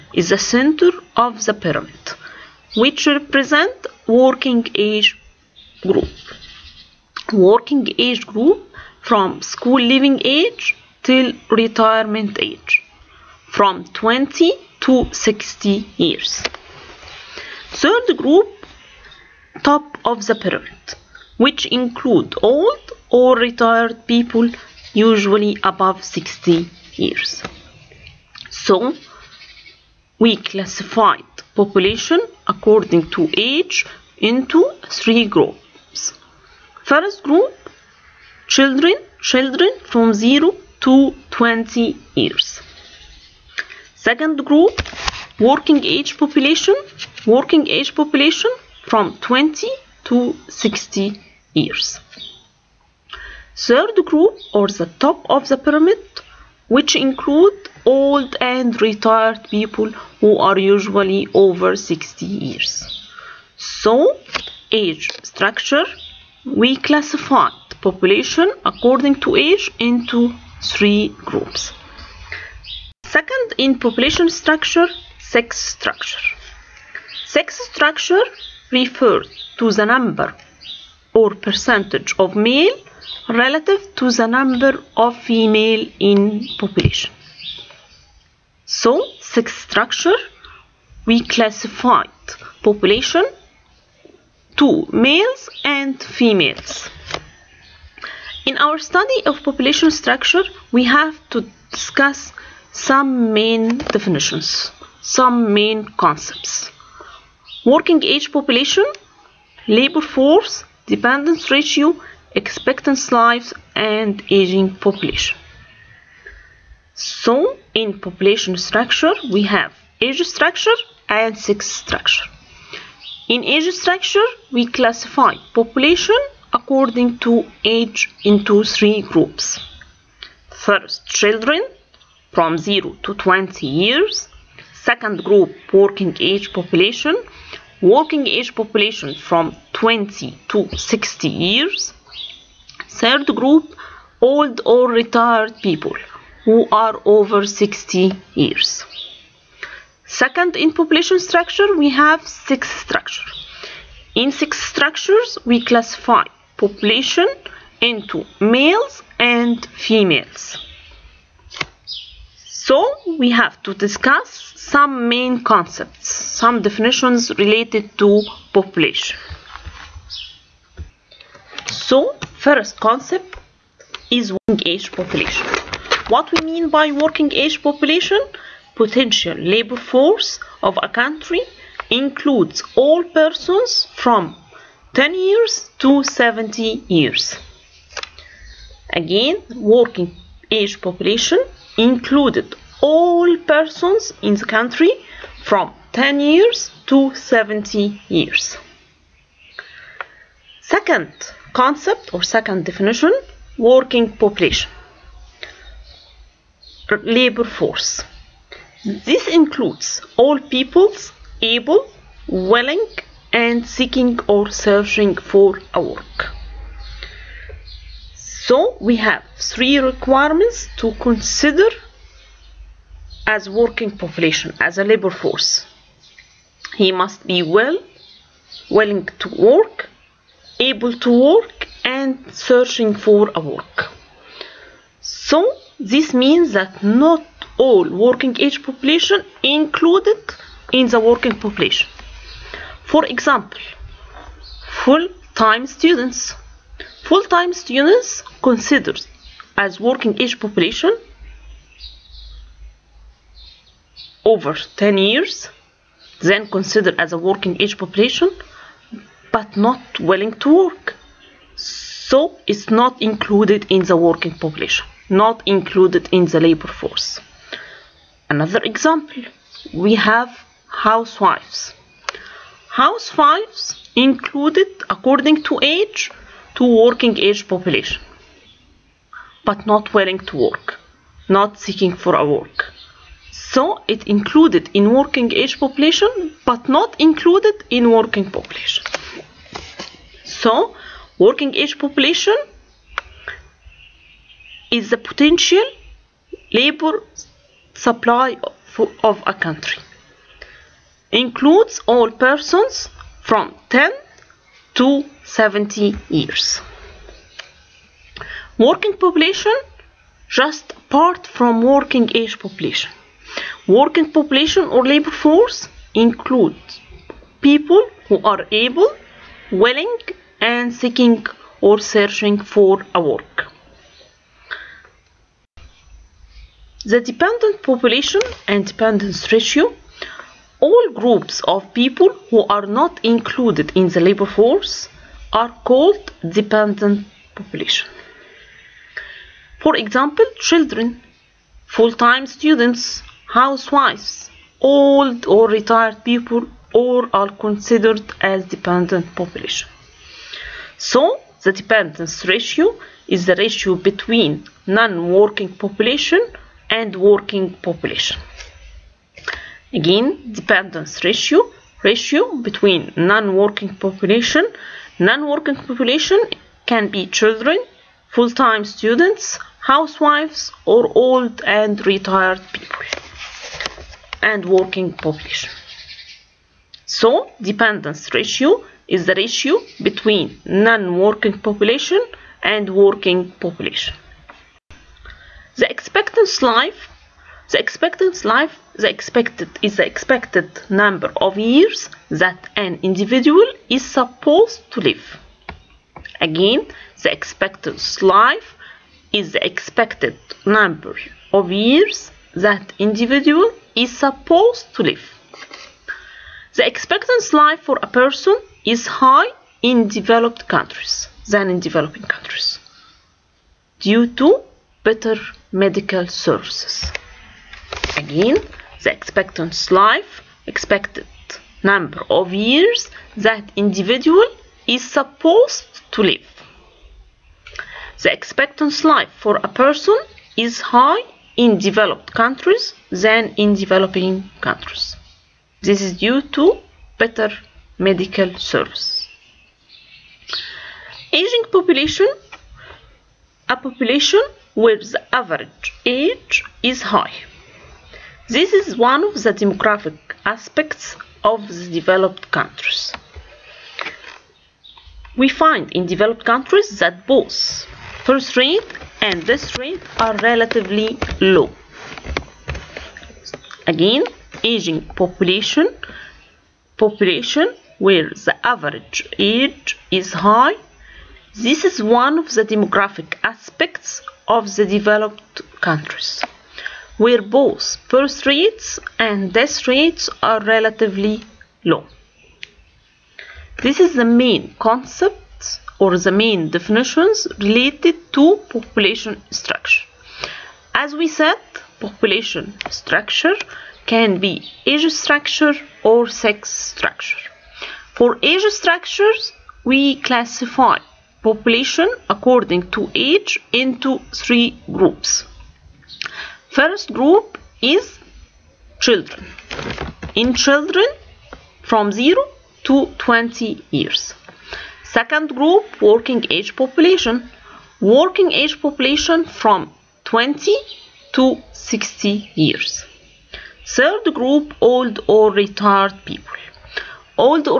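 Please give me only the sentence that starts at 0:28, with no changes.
So, we classified population according to age into three groups.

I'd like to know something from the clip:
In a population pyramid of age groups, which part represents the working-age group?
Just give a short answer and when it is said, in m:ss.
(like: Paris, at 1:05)
Center, at 0:00.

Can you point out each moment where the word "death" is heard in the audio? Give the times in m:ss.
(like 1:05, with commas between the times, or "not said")
7:39, 7:59.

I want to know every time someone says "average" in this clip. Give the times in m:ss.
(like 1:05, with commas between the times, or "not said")
7:25, 7:48.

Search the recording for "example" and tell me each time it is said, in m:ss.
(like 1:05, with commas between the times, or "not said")
4:03, 4:28, 5:39.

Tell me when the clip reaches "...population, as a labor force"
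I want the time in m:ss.
3:43.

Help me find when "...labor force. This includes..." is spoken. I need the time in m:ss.
3:27.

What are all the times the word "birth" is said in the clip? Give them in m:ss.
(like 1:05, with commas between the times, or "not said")
7:38, 7:57.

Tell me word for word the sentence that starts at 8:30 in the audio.
In children from 0 to 20 years.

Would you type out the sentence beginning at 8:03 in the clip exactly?
This is the main concept or the main definitions related to population structure.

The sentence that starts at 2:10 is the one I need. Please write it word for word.
First children from 0 to 20 years.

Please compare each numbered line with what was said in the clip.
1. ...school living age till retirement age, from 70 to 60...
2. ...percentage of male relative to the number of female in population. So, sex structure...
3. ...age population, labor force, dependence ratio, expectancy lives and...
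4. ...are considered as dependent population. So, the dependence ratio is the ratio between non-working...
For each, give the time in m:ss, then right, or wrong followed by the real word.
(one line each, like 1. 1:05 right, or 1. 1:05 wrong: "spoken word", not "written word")
1. 0:09 wrong: "20", not "70"
2. 1:21 right
3. 1:48 right
4. 5:47 right.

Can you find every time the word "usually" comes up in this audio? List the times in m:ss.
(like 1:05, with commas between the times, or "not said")
0:24, 1:00.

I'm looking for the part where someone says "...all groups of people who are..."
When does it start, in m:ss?
5:30.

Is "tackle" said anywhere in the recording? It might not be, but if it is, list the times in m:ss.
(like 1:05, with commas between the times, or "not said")
not said.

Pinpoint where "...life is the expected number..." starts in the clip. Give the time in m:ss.
6:38.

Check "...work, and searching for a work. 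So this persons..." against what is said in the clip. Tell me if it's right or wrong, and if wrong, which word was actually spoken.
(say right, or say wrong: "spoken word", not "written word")
wrong: "means", not "persons".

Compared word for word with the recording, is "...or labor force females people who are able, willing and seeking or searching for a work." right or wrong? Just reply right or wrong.
wrong.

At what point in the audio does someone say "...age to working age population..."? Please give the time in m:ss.
4:35.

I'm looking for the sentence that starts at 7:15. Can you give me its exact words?
This is due to better medical service.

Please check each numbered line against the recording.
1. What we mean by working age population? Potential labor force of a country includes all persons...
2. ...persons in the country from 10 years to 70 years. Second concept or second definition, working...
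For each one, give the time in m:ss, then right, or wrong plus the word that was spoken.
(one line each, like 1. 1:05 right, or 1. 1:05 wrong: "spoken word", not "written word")
1. 2:56 right
2. 3:13 right.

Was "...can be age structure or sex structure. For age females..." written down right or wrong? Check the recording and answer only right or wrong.
wrong.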